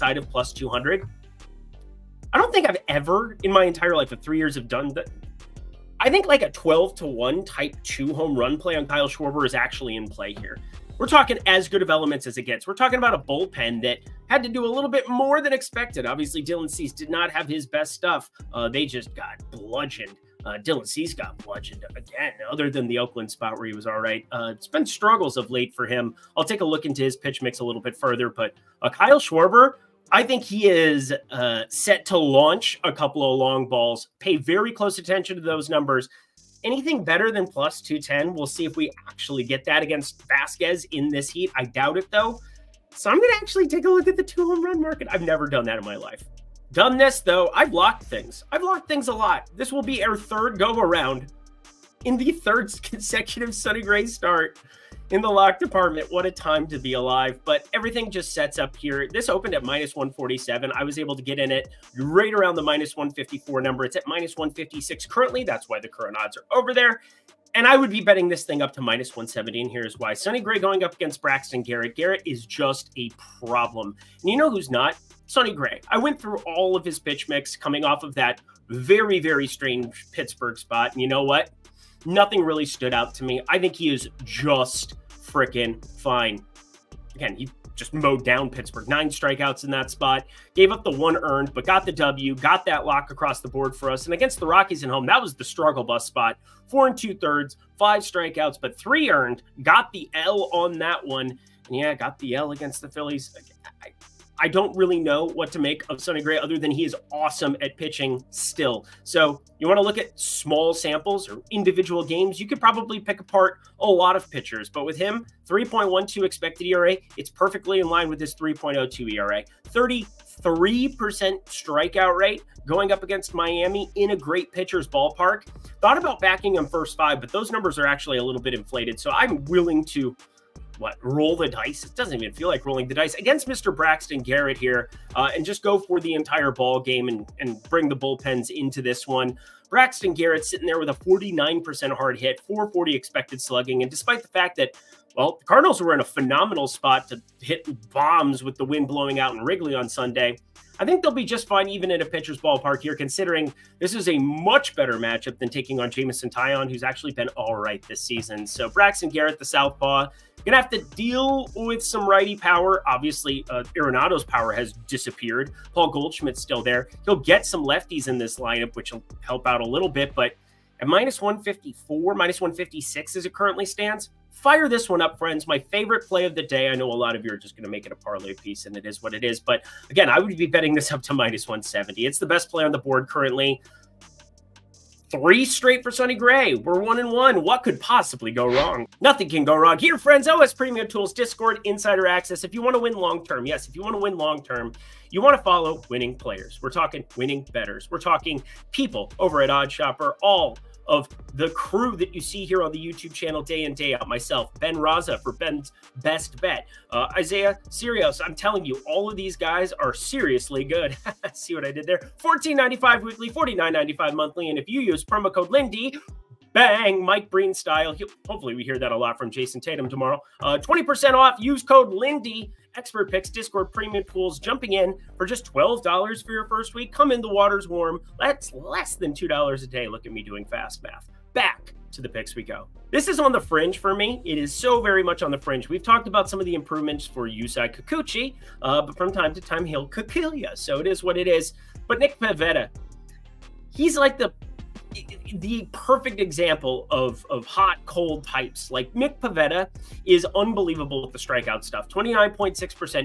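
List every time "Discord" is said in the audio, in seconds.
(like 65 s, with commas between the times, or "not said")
191 s, 223 s.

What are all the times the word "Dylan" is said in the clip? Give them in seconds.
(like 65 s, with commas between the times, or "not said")
16 s, 20 s.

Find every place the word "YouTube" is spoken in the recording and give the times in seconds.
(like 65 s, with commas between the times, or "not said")
202 s.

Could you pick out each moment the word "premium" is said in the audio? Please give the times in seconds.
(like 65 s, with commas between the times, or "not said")
190 s, 223 s.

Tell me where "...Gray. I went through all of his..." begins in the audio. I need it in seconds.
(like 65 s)
75 s.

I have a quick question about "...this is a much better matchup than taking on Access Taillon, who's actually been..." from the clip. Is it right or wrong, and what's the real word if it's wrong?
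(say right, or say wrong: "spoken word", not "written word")
wrong: "Jameson", not "Access".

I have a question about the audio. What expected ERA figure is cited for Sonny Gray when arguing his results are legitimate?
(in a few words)
3.12.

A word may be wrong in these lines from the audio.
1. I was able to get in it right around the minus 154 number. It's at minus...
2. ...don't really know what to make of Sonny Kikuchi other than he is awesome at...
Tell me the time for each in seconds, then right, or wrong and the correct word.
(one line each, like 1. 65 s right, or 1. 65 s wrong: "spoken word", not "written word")
1. 60 s right
2. 104 s wrong: "Gray", not "Kikuchi".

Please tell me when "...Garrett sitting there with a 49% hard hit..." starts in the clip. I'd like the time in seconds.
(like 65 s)
140 s.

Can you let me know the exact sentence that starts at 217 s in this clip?
He'll, hopefully, we hear that a lot from Jayson Tatum tomorrow.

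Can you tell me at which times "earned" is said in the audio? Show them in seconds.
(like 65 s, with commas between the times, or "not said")
91 s, 99 s.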